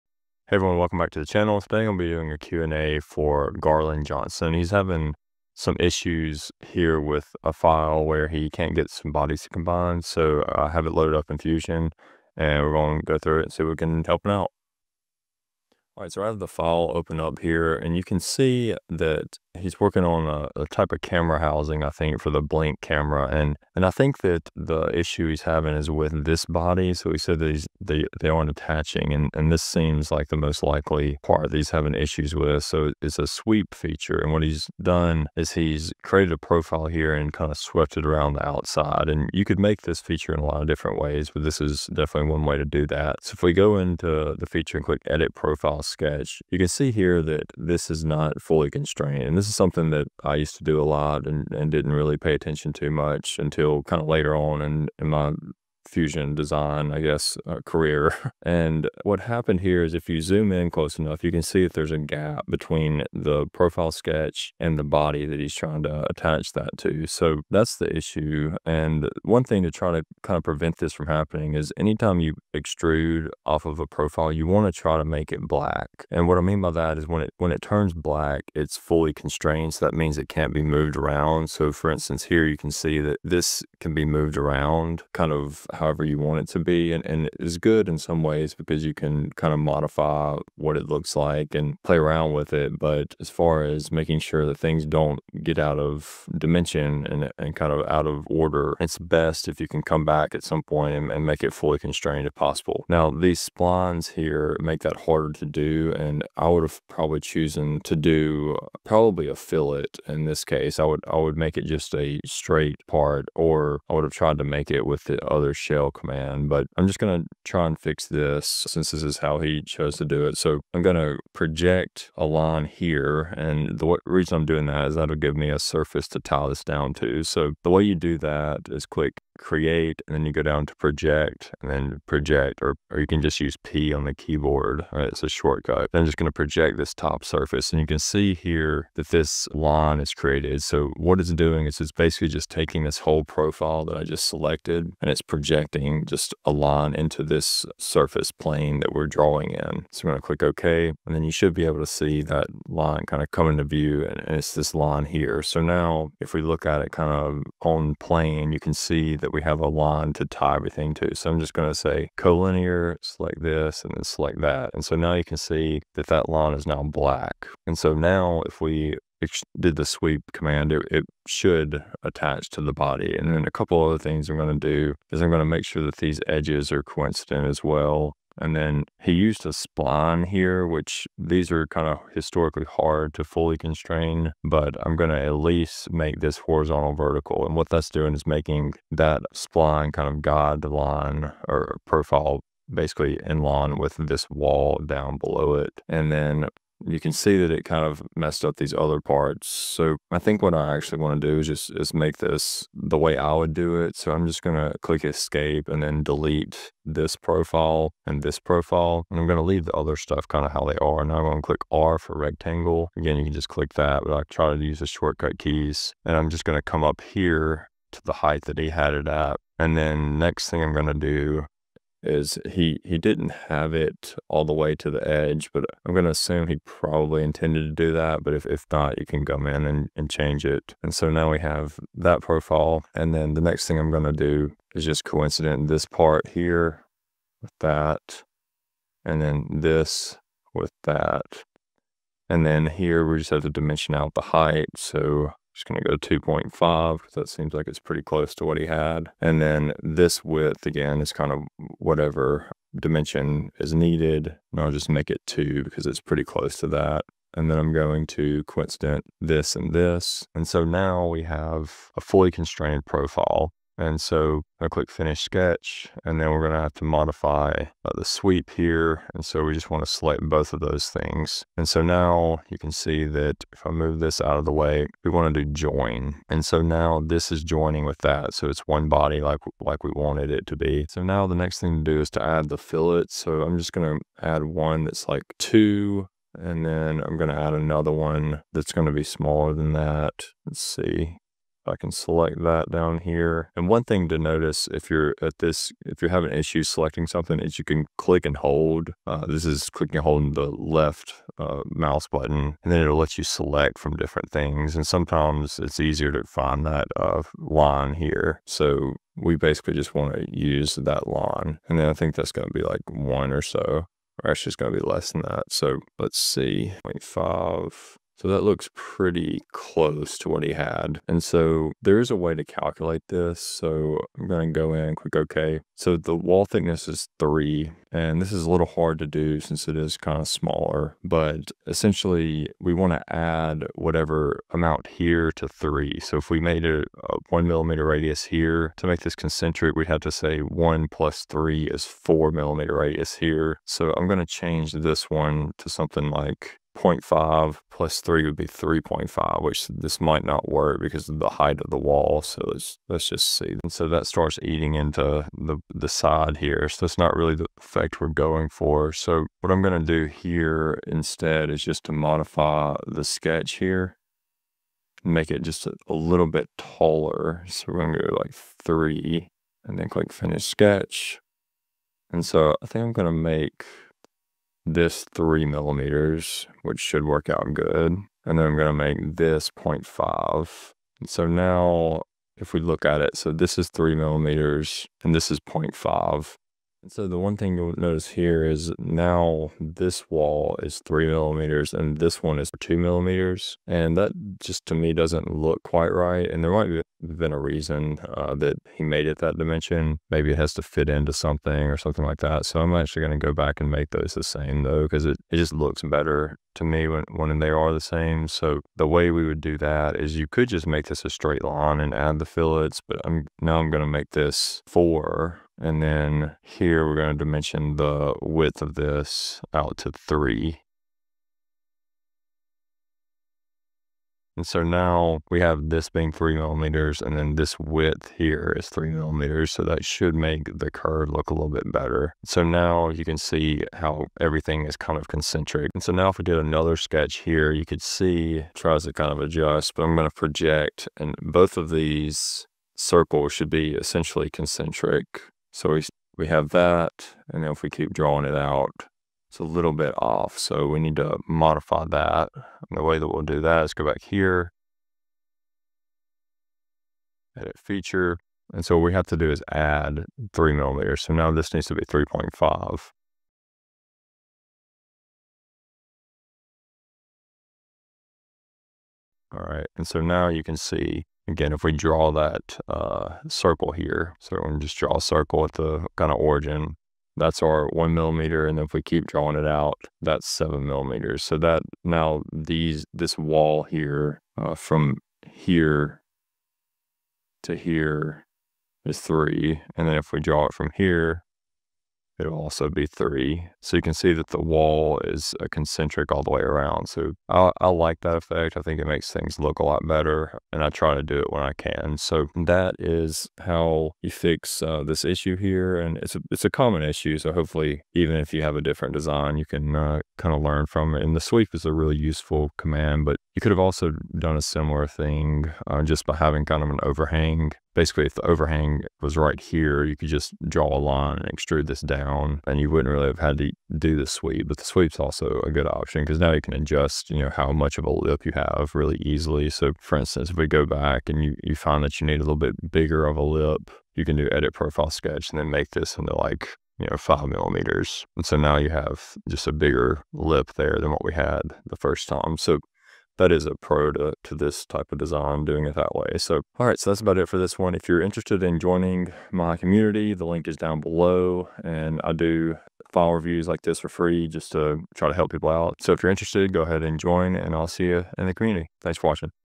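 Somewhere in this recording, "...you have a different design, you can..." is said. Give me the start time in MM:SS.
08:28.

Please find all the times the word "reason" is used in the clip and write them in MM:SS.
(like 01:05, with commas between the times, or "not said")
02:04, 06:37.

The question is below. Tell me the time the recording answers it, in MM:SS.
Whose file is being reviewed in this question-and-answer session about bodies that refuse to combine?
00:03.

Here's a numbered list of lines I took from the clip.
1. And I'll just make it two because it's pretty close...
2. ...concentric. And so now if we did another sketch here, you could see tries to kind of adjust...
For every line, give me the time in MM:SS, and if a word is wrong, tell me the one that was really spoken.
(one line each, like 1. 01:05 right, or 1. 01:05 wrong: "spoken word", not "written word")
1. 04:14 right
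2. 07:15 right.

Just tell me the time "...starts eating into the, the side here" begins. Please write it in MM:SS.
05:54.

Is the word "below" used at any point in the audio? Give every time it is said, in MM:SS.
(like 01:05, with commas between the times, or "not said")
03:15, 09:10.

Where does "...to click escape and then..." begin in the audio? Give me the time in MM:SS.
03:24.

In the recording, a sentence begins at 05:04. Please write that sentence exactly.
And sometimes it's easier to find that uh, line here.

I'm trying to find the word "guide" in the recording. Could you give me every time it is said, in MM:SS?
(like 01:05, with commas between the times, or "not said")
03:10.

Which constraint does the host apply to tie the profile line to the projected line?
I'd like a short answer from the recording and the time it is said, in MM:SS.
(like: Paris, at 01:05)
Collinear, at 02:42.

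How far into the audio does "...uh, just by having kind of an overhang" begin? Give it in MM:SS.
08:35.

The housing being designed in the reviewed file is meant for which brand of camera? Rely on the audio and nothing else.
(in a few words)
Blink.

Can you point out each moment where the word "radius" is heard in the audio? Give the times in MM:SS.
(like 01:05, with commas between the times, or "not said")
05:37, 05:42.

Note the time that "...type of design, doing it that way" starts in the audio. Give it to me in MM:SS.
09:04.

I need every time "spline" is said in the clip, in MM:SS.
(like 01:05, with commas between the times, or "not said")
01:43, 02:59, 03:09.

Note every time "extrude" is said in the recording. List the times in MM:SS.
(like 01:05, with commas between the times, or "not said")
01:12, 08:41.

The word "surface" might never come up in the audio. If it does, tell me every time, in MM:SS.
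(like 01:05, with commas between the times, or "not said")
02:05, 02:17, 02:27.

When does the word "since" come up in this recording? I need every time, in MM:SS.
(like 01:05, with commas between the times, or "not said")
01:58, 05:29.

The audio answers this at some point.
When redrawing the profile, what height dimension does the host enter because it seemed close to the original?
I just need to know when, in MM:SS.
04:06.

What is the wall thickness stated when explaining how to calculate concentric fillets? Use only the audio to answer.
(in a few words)
3 millimeters.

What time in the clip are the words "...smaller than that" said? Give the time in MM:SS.
04:49.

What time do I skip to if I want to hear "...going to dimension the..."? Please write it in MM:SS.
06:56.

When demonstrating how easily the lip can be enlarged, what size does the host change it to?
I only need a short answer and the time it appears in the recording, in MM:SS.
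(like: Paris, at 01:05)
5 millimeters, at 08:56.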